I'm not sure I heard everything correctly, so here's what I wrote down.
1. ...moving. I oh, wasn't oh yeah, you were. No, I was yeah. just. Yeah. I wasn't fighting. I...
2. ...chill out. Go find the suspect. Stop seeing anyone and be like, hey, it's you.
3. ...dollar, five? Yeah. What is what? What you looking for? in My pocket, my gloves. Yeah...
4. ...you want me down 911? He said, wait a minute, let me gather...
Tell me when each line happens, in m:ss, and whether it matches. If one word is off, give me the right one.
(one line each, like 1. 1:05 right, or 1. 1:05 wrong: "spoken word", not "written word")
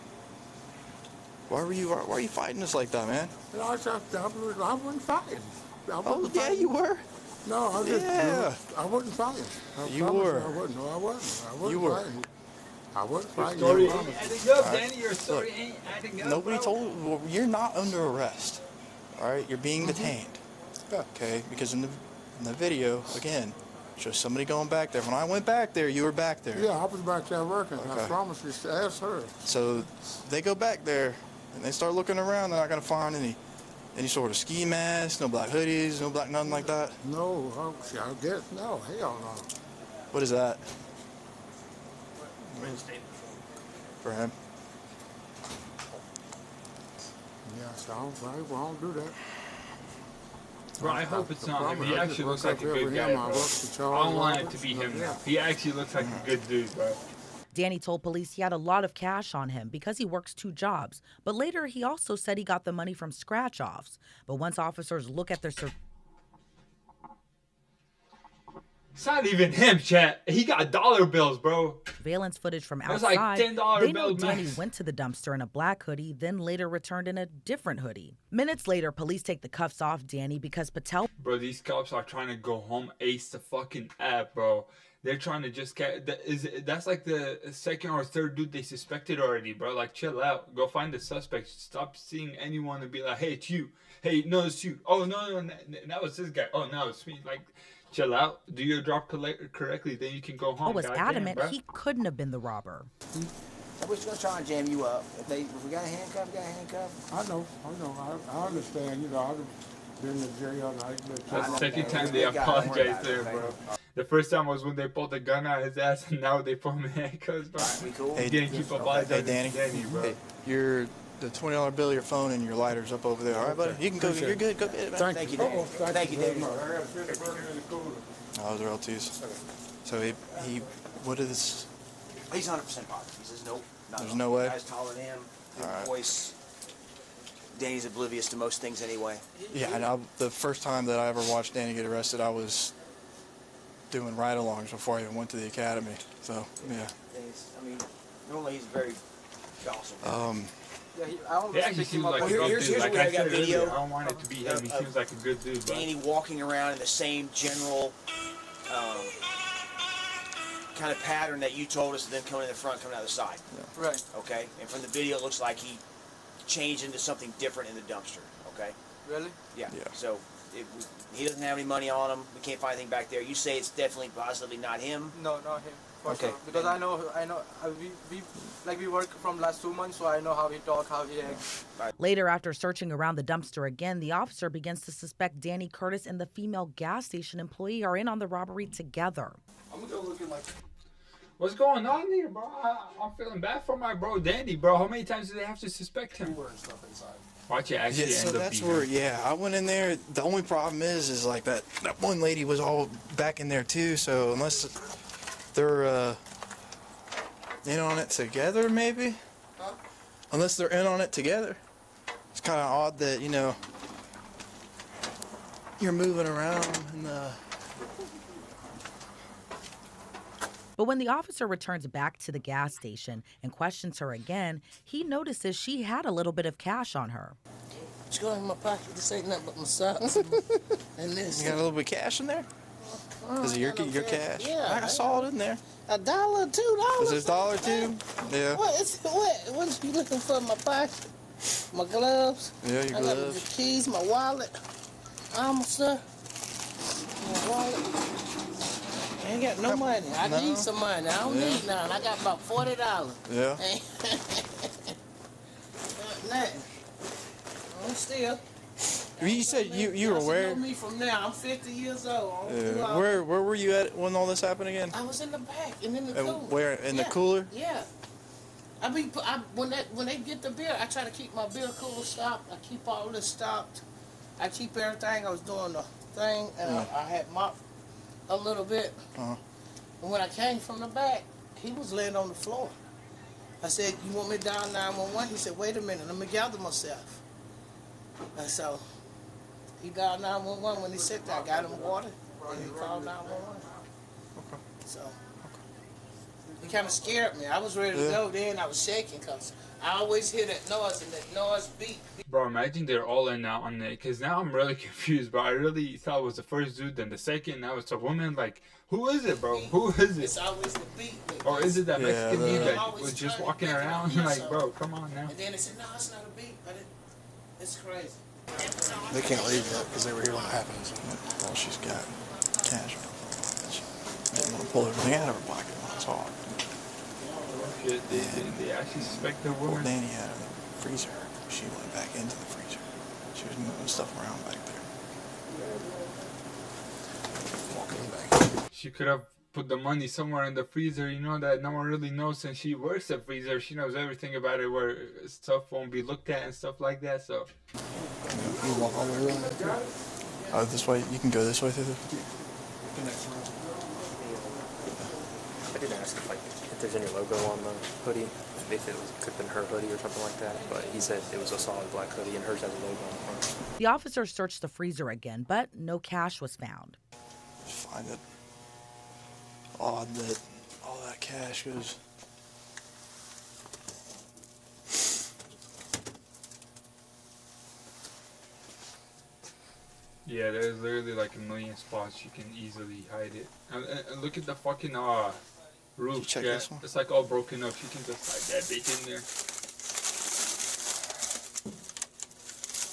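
1. 0:05 wrong: "fighting", not "moving"
2. 1:29 right
3. 3:57 wrong: "two", not "five"
4. 4:44 right.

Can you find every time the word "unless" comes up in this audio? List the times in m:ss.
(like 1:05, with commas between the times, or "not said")
3:24, 3:30.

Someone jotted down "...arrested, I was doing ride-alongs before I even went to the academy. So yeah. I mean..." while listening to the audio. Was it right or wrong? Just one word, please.
right.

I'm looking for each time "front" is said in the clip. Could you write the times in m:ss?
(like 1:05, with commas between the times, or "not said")
2:42, 6:03.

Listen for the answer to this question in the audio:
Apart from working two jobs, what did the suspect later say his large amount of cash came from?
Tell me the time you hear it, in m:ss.
1:03.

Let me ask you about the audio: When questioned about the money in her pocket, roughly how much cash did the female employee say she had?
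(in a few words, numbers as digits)
$40.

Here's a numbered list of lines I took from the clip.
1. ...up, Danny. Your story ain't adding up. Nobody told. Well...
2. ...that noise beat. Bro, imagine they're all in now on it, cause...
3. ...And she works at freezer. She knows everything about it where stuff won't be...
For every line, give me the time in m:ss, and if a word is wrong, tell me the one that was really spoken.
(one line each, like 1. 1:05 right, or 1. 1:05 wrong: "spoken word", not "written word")
1. 0:14 right
2. 5:01 right
3. 5:42 right.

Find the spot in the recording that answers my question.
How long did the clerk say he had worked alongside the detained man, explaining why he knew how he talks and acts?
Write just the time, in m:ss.
2:59.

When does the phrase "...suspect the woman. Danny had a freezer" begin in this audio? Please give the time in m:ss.
5:29.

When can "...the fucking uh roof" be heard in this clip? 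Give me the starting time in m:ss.
6:24.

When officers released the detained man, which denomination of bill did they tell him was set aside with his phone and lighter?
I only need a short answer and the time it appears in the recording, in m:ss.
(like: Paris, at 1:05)
$20, at 2:01.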